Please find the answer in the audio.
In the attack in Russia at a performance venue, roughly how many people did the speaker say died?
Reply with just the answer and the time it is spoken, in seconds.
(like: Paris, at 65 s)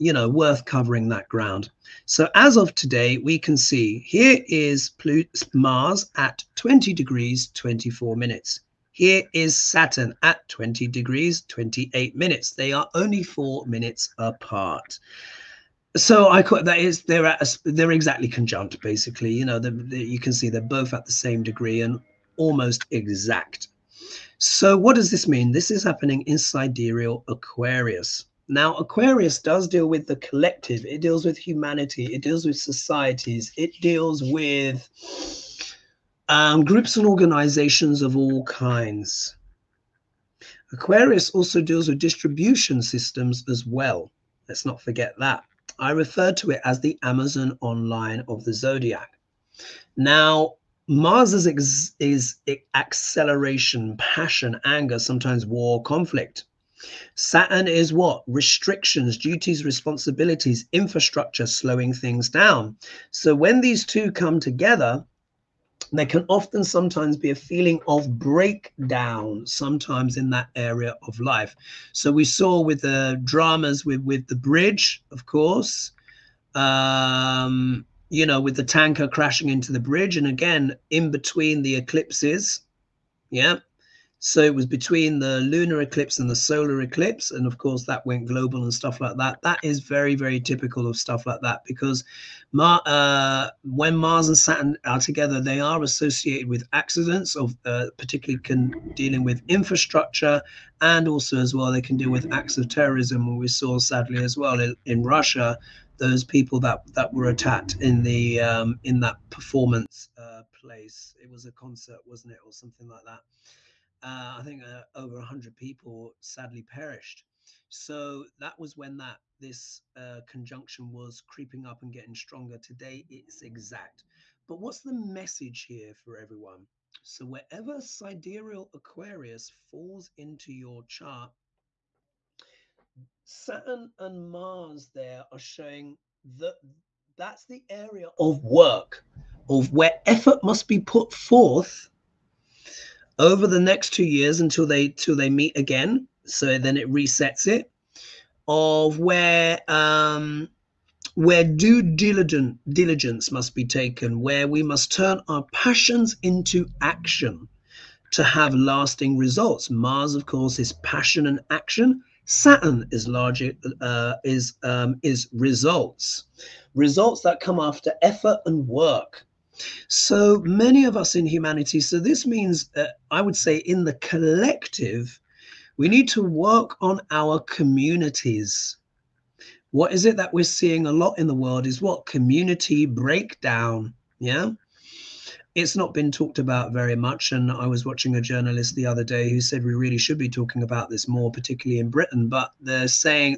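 over 100, at 114 s.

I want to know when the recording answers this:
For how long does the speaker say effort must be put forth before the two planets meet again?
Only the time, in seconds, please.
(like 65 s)
143 s.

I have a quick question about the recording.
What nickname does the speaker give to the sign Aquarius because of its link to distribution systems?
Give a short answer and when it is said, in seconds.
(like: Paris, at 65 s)
Amazon online of the zodiac, at 47 s.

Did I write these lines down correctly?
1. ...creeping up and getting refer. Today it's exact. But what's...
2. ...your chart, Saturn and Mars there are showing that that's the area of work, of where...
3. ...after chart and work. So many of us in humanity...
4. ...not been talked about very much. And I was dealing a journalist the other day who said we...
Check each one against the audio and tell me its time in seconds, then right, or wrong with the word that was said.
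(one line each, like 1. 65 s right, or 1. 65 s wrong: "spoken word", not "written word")
1. 121 s wrong: "stronger", not "refer"
2. 130 s right
3. 167 s wrong: "effort", not "chart"
4. 185 s wrong: "watching", not "dealing".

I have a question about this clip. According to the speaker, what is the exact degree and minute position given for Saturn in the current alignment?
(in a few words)
20 degrees 28 minutes.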